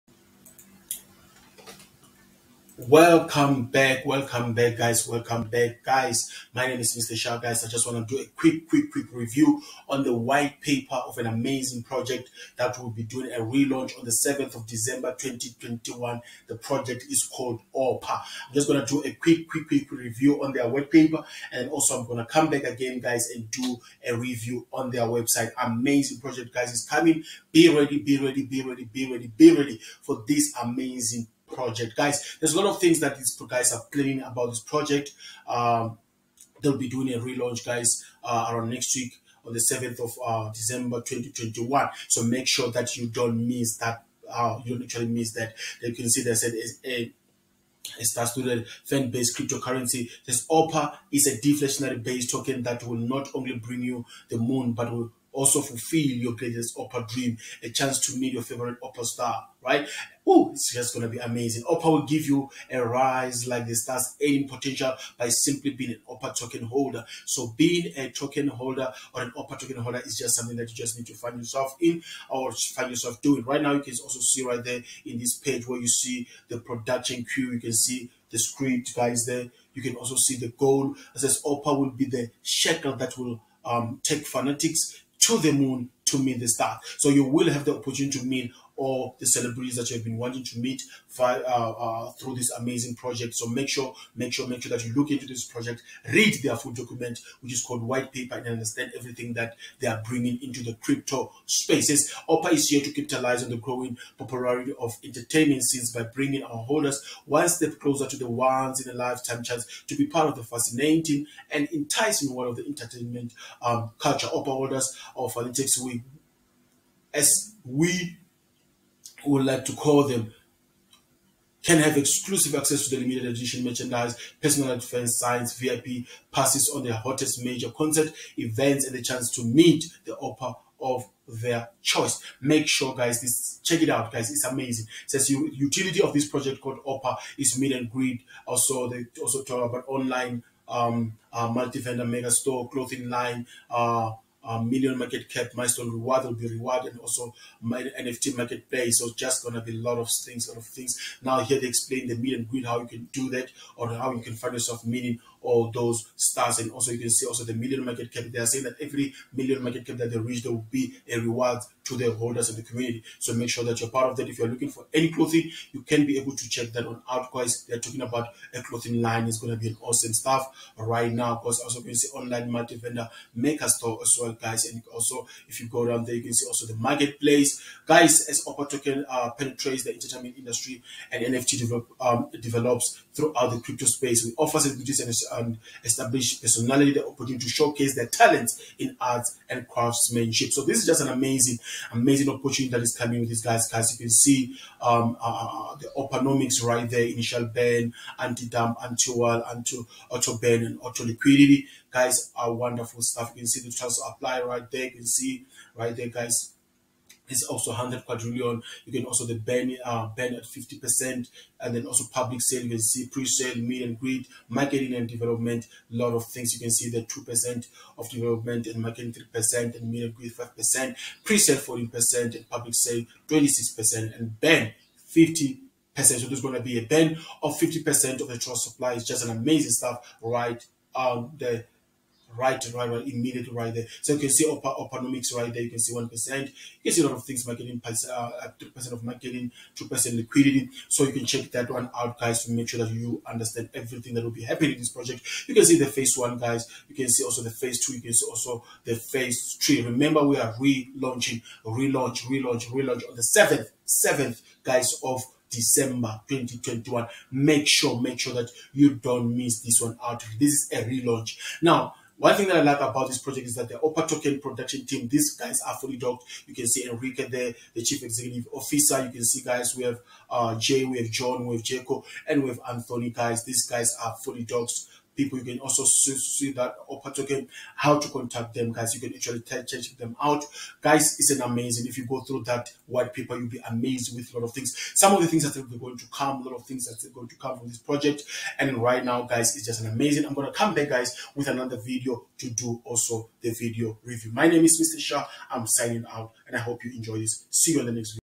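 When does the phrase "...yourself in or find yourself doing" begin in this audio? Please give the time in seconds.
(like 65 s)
71 s.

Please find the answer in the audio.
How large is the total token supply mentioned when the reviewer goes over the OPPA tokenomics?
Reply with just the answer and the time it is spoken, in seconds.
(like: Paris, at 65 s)
100 quadrillion, at 207 s.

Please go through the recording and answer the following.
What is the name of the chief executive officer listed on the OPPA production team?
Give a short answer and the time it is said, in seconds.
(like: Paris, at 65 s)
Enrique, at 266 s.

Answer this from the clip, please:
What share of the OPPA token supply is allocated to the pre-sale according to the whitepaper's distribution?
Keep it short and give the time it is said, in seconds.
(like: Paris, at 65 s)
14%, at 221 s.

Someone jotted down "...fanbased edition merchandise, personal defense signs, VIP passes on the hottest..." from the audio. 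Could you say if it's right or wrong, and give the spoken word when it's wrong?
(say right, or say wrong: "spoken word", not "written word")
wrong: "limited", not "fanbased".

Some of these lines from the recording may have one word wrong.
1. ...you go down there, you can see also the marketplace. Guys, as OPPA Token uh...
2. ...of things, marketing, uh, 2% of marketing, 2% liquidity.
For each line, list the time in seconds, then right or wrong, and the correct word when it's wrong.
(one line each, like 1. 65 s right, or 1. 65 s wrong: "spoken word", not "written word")
1. 175 s right
2. 237 s right.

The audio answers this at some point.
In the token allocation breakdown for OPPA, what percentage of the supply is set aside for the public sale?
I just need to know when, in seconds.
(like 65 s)
222 s.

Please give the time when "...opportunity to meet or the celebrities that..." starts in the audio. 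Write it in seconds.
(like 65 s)
87 s.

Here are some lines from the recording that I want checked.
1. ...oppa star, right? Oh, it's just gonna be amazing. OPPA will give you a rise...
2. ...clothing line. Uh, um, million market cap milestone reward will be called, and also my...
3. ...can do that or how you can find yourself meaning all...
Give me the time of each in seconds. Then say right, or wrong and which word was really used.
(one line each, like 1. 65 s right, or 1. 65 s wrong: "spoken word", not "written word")
1. 58 s right
2. 142 s wrong: "rewarded", not "called"
3. 152 s right.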